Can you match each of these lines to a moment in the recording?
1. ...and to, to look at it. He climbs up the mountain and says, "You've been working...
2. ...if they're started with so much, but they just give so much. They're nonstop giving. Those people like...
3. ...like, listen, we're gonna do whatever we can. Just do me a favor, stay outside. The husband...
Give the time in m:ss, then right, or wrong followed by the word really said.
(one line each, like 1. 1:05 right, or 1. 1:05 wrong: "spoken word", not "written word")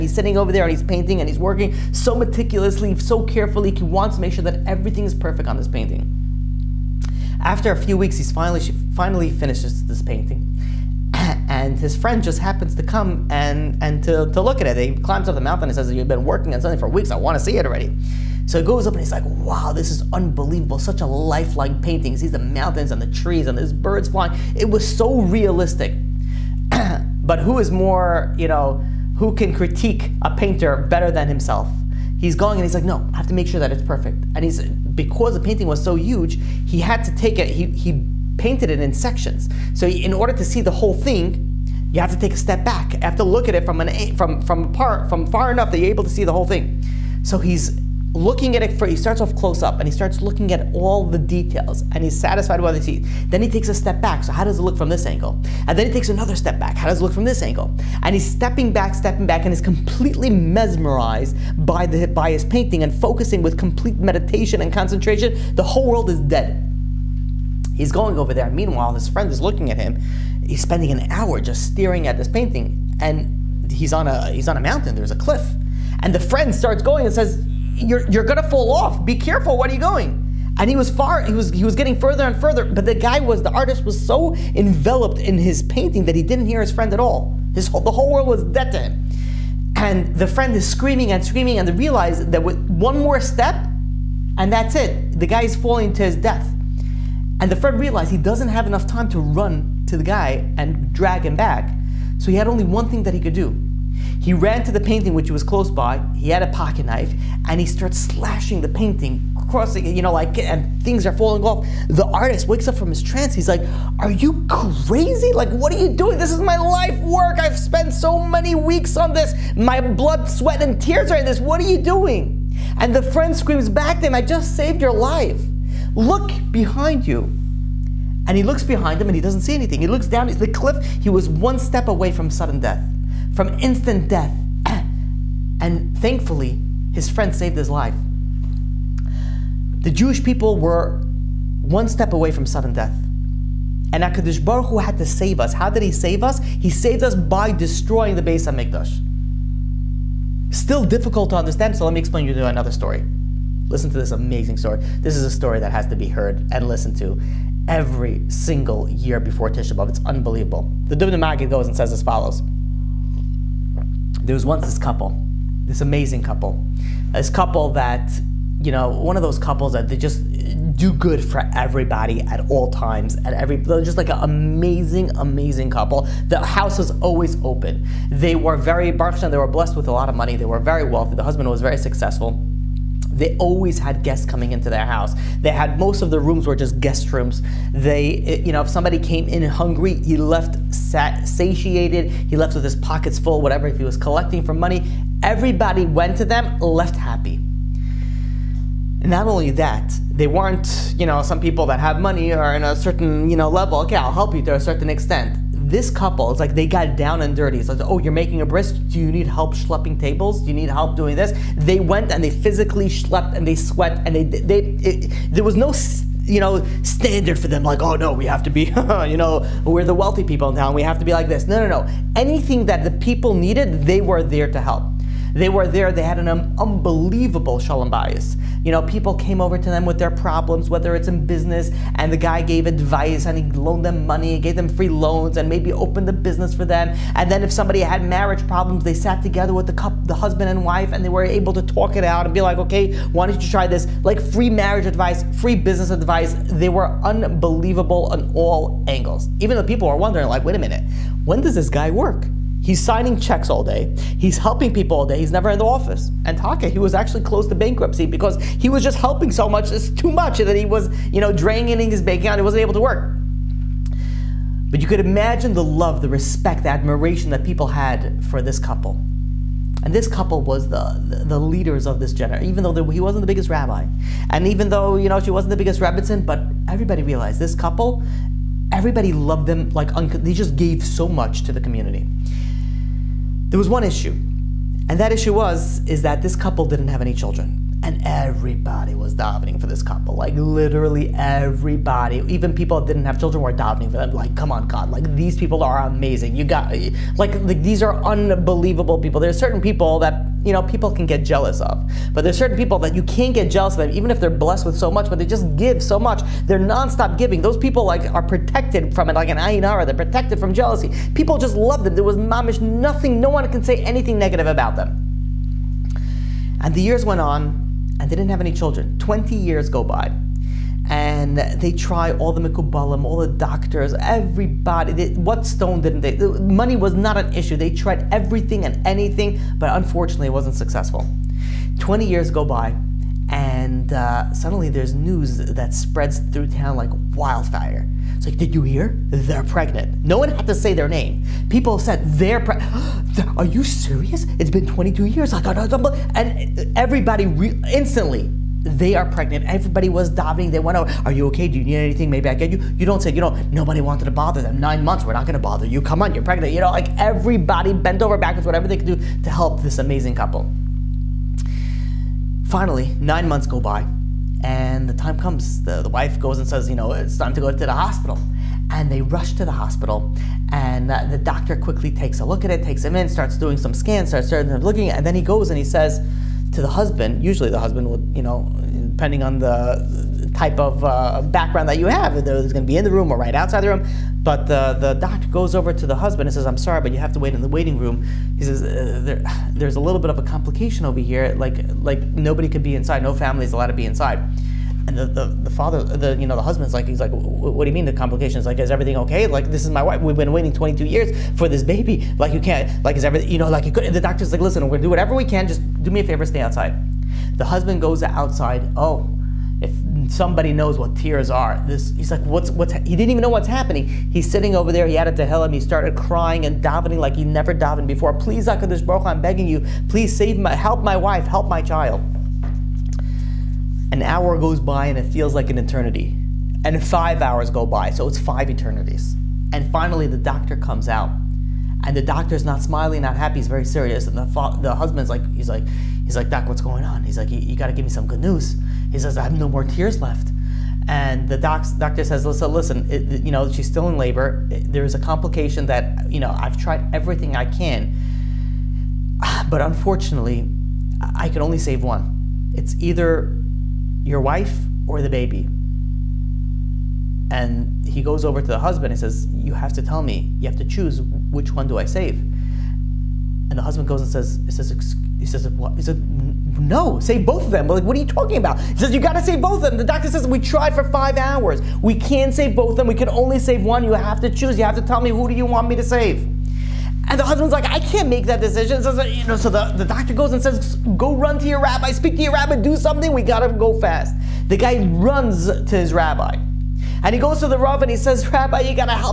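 1. 0:13 right
2. 5:04 wrong: "blessed", not "started"
3. 6:44 right.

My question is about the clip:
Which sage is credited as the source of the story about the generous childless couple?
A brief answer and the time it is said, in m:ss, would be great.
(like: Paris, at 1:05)
The Dubna Magid, at 2:40.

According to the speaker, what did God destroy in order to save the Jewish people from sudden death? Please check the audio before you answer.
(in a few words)
Beis HaMikdash.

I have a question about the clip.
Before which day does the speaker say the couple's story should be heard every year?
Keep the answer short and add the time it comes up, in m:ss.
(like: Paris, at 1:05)
Tisha B'Av, at 2:39.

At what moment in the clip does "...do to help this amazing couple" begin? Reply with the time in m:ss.
5:58.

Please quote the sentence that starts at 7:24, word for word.
There is a complication that, you know, I've tried everything I can.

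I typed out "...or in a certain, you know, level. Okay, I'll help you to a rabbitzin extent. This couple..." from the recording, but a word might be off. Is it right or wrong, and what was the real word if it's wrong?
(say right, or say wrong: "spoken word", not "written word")
wrong: "certain", not "rabbitzin".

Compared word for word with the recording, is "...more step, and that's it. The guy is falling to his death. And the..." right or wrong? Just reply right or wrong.
right.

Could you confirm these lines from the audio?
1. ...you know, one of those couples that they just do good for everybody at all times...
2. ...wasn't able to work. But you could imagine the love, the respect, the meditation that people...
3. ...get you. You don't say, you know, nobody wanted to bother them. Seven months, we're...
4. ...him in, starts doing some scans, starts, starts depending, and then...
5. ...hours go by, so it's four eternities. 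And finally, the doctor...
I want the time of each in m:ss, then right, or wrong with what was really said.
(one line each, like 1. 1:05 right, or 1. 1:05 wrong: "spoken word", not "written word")
1. 2:48 right
2. 4:22 wrong: "admiration", not "meditation"
3. 5:52 wrong: "Nine", not "Seven"
4. 6:12 wrong: "looking", not "depending"
5. 7:07 wrong: "five", not "four".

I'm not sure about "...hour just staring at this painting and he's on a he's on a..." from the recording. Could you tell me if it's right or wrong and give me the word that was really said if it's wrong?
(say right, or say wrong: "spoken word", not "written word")
right.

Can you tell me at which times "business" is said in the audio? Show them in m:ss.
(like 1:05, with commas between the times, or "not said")
3:51, 3:56, 4:05.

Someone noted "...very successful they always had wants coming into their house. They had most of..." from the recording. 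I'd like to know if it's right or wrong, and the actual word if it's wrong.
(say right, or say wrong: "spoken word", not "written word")
wrong: "guests", not "wants".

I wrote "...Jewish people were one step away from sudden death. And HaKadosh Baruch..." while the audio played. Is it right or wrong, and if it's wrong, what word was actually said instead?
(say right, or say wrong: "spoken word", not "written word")
right.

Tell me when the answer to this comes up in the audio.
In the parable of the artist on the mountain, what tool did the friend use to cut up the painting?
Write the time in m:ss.
1:46.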